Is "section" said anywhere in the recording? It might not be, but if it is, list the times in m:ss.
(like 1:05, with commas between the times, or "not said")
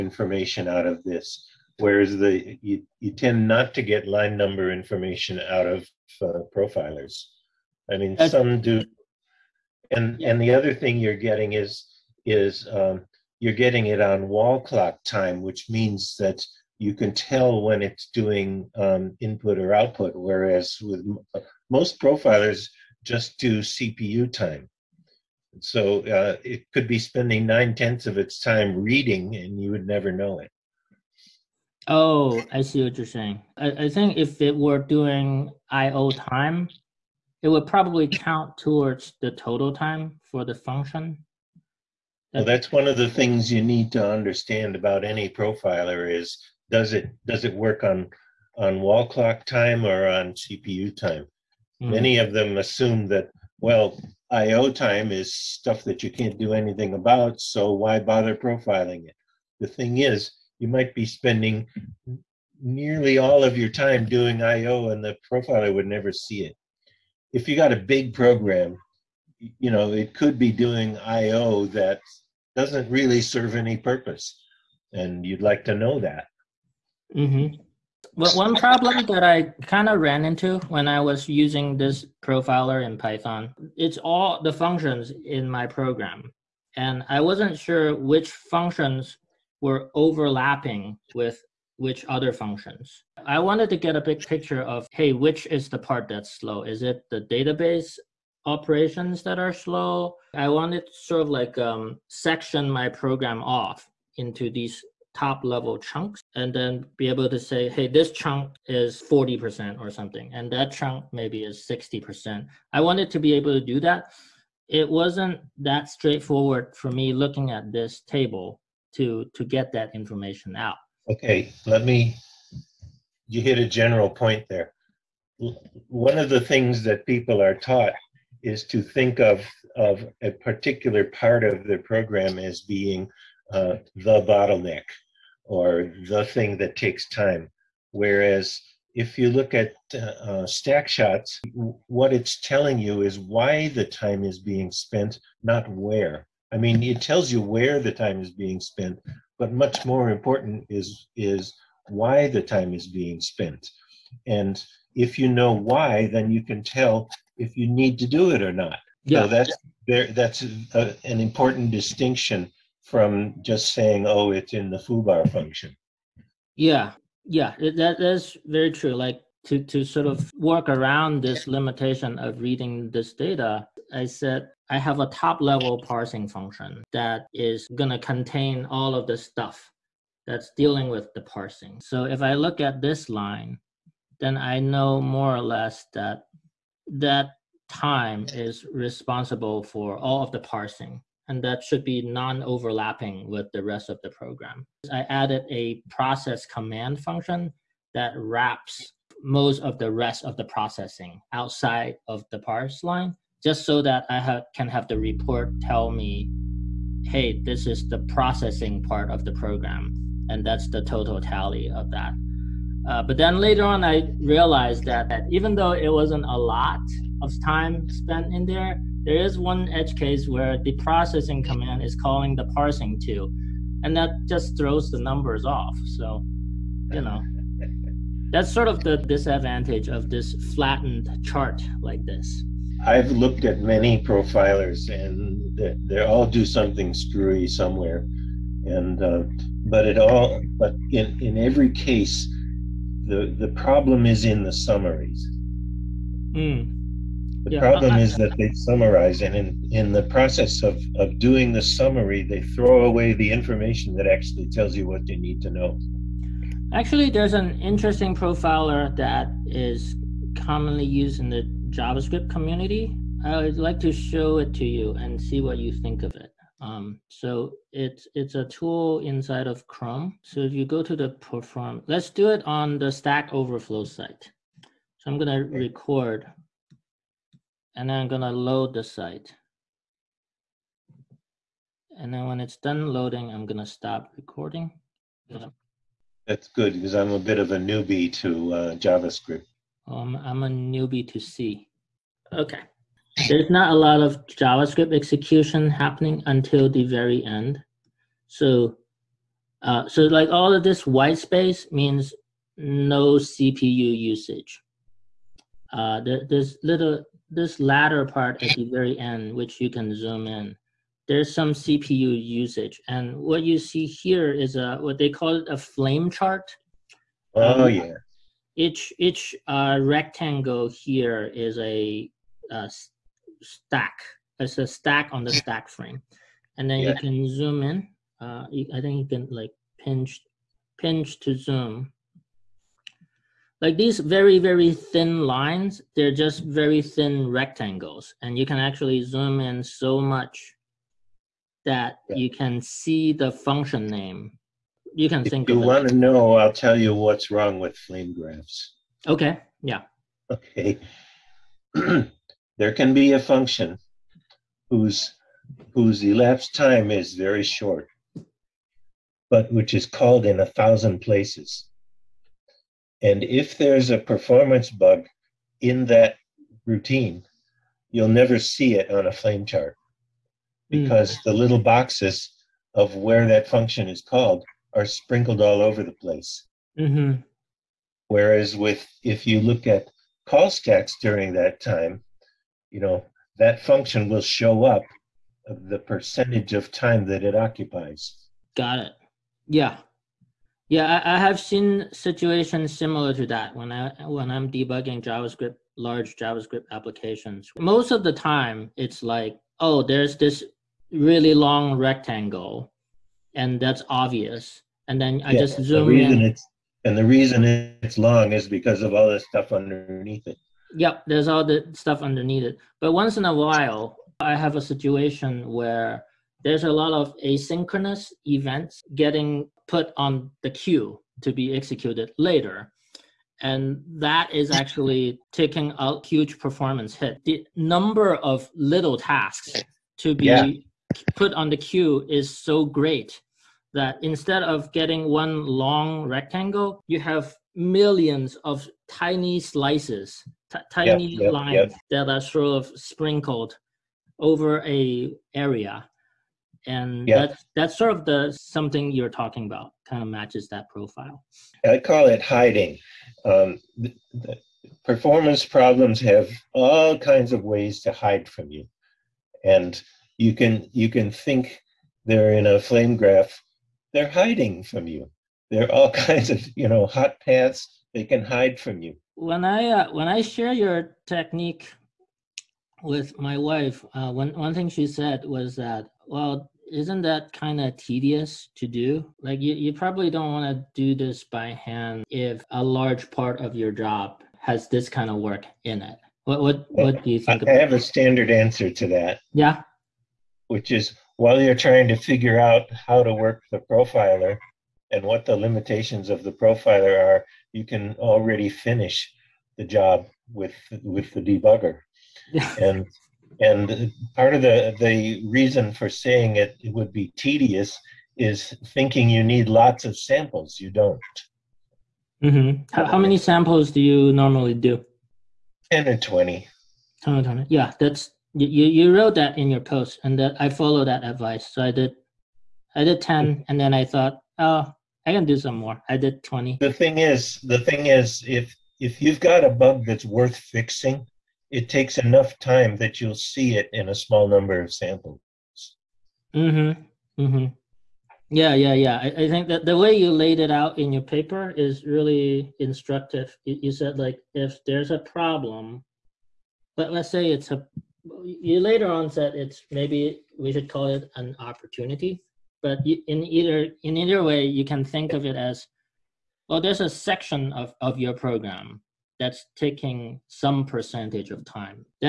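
1:42, 9:16.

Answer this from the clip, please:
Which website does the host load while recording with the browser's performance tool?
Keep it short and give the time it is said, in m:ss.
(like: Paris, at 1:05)
Stack Overflow, at 4:32.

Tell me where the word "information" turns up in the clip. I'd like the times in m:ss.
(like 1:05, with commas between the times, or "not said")
0:04, 1:59, 4:13.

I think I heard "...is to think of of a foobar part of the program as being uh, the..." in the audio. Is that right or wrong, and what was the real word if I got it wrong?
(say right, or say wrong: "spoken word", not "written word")
wrong: "particular", not "foobar".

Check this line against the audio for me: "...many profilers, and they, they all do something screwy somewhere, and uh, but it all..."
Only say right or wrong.
right.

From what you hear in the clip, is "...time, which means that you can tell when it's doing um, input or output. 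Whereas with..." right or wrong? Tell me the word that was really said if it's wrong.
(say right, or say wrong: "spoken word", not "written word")
right.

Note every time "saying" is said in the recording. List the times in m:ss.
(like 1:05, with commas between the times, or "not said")
0:33, 2:43, 8:25.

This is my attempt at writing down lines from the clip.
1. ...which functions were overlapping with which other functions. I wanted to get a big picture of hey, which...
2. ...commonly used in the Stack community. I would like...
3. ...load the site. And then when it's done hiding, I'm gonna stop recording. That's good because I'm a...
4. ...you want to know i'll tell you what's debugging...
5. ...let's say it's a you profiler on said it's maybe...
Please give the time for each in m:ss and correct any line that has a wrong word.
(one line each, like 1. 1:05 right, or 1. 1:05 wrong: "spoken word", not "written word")
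1. 1:27 right
2. 4:20 wrong: "JavaScript", not "Stack"
3. 4:38 wrong: "loading", not "hiding"
4. 5:45 wrong: "wrong", not "debugging"
5. 9:06 wrong: "later", not "profiler".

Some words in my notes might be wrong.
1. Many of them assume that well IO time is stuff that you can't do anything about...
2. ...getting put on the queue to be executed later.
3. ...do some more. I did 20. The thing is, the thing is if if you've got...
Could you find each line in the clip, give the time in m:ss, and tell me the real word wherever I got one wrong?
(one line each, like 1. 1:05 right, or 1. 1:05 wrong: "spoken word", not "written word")
1. 0:51 right
2. 6:58 right
3. 8:45 right.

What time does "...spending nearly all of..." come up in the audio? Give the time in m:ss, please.
1:01.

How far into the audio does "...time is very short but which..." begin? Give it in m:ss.
5:56.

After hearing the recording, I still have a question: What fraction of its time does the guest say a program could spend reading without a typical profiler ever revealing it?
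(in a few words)
nine tenths.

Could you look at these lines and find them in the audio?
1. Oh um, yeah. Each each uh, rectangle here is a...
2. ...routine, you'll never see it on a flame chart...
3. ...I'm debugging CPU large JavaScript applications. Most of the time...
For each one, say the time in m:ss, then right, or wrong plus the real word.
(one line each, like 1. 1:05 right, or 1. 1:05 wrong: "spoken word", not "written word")
1. 5:17 right
2. 6:06 right
3. 6:34 wrong: "JavaScript", not "CPU".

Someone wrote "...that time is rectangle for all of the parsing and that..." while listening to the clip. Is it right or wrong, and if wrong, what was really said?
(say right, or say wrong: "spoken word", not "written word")
wrong: "responsible", not "rectangle".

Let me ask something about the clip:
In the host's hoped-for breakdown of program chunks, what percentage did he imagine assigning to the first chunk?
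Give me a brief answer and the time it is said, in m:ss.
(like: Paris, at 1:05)
40%, at 1:49.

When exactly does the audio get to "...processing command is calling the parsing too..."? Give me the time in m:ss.
3:40.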